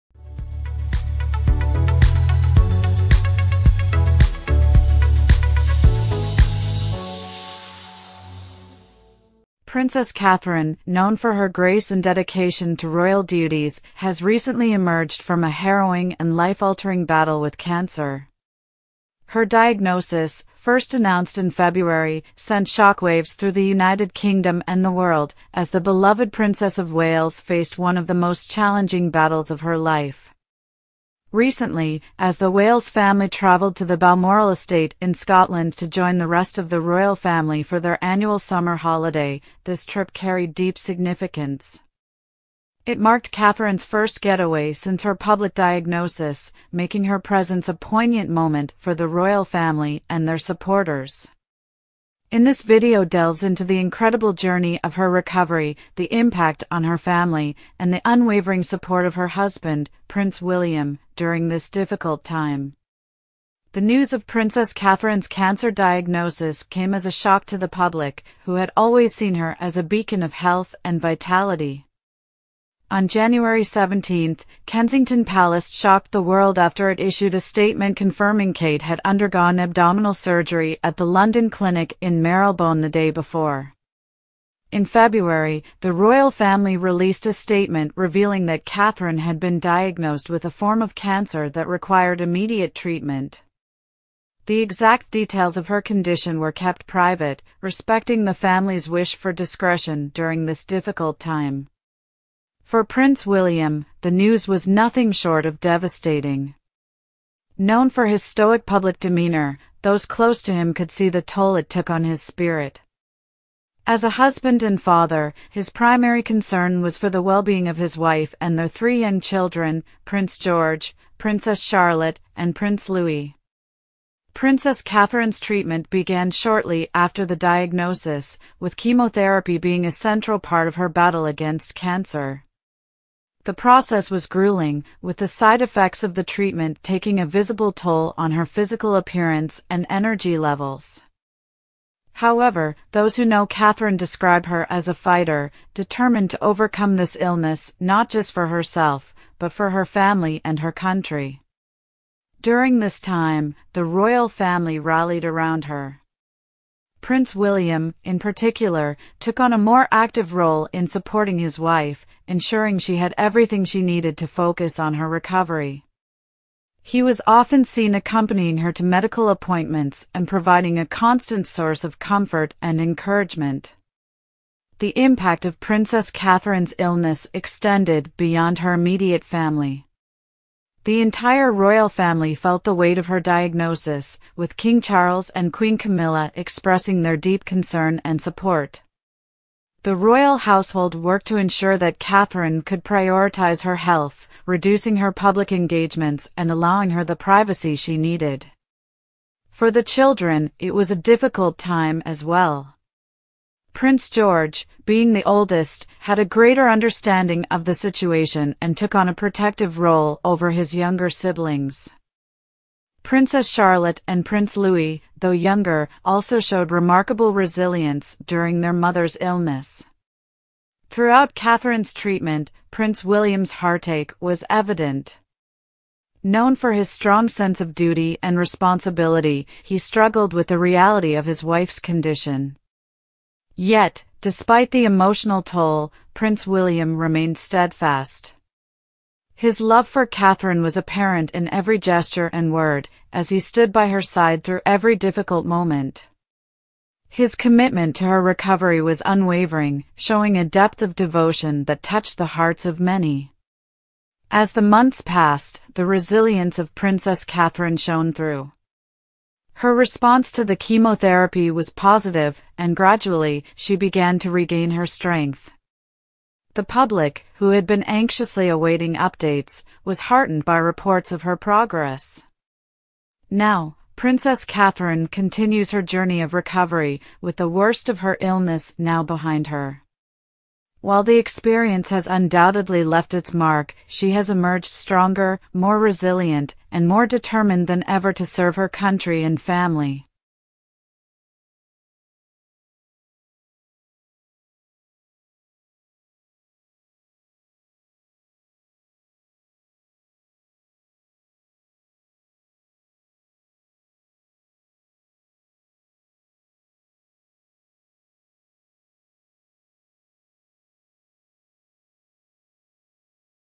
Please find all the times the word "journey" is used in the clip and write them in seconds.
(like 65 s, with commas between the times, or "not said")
54 s, 275 s.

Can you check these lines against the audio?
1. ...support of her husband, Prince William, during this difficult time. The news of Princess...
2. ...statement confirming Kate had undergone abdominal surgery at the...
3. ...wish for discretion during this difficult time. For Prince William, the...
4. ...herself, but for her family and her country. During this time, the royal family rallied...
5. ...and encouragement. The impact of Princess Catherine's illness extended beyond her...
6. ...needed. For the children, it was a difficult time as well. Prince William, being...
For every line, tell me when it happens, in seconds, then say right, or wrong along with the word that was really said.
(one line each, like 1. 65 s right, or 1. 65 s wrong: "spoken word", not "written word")
1. 58 s right
2. 77 s right
3. 98 s right
4. 148 s right
5. 172 s right
6. 197 s wrong: "George", not "William".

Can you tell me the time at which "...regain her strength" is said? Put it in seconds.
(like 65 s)
264 s.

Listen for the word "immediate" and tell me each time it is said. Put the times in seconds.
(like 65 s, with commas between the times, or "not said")
92 s, 178 s.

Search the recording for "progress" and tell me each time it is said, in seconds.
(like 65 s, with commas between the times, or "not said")
271 s.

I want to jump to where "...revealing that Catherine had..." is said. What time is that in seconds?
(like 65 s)
87 s.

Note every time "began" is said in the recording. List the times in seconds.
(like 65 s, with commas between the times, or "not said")
125 s, 263 s.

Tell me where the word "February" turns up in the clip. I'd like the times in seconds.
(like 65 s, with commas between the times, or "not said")
21 s, 84 s.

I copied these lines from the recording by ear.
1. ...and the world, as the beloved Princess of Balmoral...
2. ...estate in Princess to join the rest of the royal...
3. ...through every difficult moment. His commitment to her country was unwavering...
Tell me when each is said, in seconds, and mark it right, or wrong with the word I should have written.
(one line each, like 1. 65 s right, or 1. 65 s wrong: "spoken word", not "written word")
1. 24 s wrong: "Wales", not "Balmoral"
2. 34 s wrong: "Scotland", not "Princess"
3. 244 s wrong: "recovery", not "country".